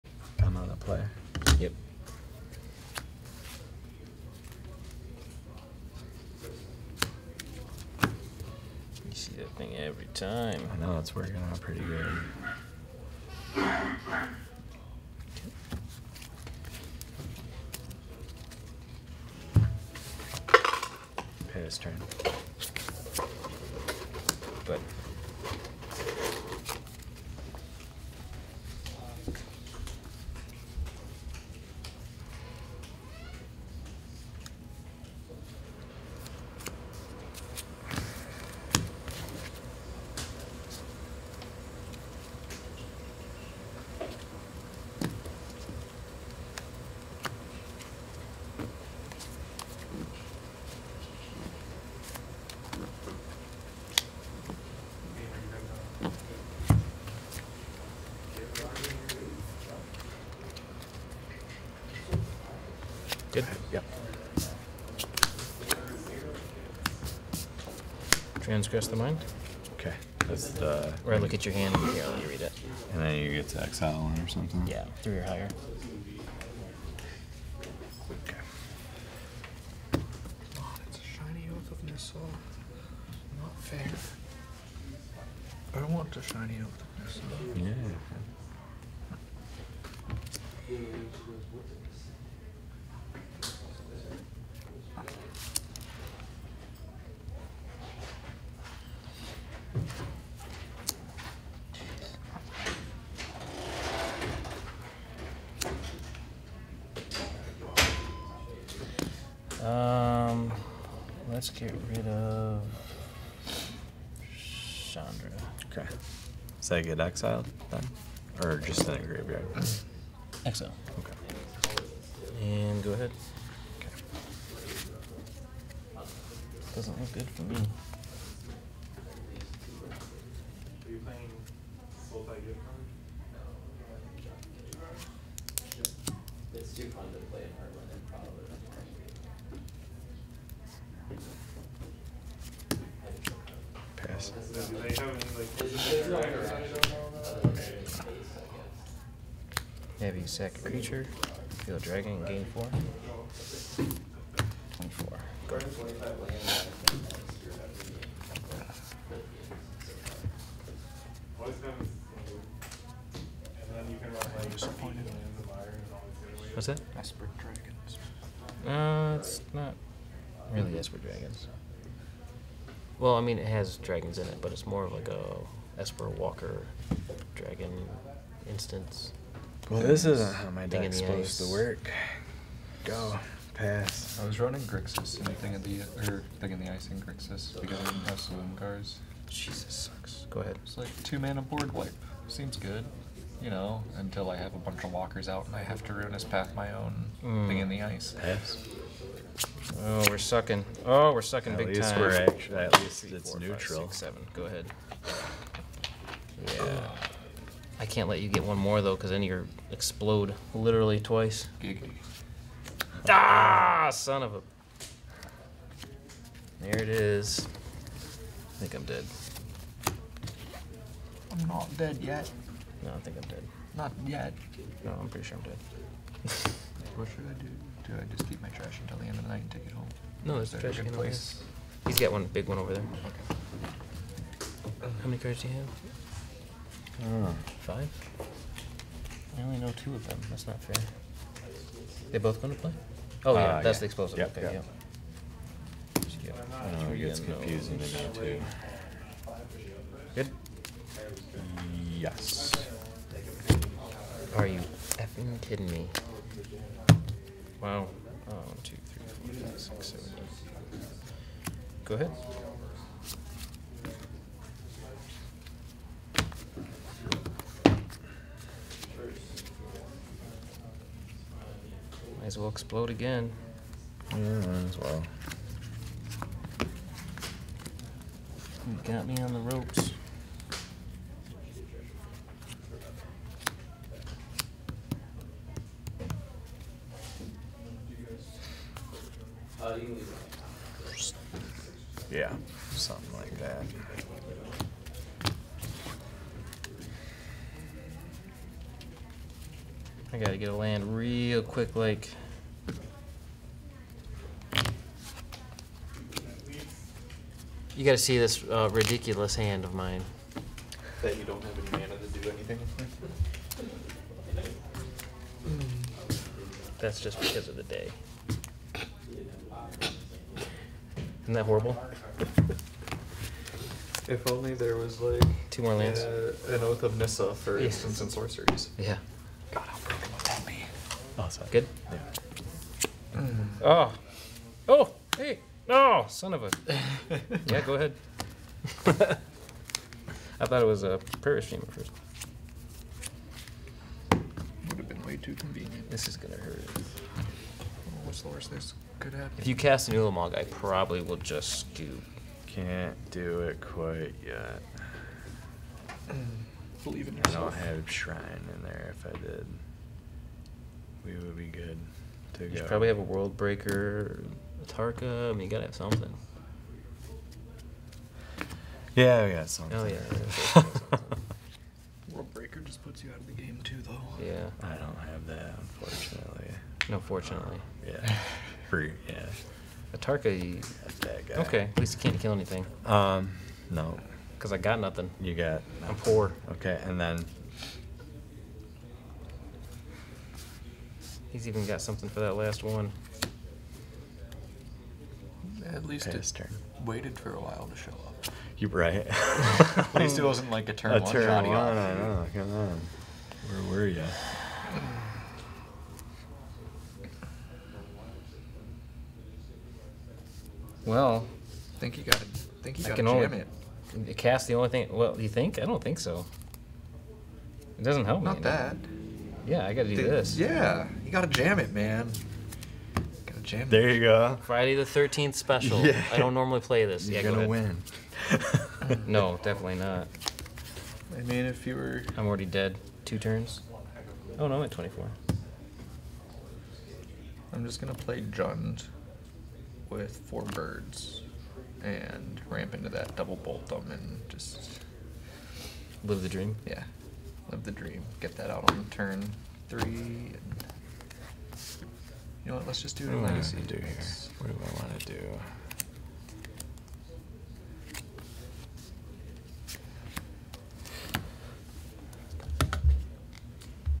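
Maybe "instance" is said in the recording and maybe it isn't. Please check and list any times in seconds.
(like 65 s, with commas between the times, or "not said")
178 s, 327 s.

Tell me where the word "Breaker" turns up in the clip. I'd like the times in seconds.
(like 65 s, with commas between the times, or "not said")
363 s, 372 s.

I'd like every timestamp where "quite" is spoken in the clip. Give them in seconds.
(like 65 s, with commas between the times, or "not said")
353 s.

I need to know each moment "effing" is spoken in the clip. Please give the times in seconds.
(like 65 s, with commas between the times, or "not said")
254 s.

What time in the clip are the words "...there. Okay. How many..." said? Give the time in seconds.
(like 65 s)
232 s.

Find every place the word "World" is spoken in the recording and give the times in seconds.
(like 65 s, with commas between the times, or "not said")
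363 s, 372 s.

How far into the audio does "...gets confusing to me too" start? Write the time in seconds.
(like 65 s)
246 s.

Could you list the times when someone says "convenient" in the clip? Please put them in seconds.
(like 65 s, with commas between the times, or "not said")
345 s.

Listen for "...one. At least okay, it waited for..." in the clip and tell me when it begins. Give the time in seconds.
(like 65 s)
392 s.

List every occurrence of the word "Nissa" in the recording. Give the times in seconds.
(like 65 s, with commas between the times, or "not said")
81 s, 87 s, 326 s.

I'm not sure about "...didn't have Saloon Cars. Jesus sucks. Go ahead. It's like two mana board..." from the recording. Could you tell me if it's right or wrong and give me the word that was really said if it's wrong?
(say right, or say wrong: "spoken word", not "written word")
right.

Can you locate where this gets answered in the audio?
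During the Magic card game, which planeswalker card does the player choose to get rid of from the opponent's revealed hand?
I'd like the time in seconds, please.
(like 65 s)
114 s.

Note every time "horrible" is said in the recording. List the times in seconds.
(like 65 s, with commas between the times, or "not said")
321 s.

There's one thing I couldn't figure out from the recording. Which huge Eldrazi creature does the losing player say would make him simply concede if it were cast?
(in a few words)
Ulamog.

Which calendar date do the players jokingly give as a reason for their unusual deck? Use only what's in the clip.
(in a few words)
Friday the Thirteenth.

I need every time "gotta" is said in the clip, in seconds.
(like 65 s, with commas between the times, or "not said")
300 s, 307 s, 365 s.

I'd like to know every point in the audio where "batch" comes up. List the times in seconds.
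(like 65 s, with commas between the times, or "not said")
not said.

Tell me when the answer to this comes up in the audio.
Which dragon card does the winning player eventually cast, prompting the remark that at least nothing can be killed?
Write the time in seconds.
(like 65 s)
379 s.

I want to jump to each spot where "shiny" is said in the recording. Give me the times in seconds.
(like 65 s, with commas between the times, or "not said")
81 s, 86 s.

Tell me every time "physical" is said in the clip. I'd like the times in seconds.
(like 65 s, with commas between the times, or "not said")
145 s.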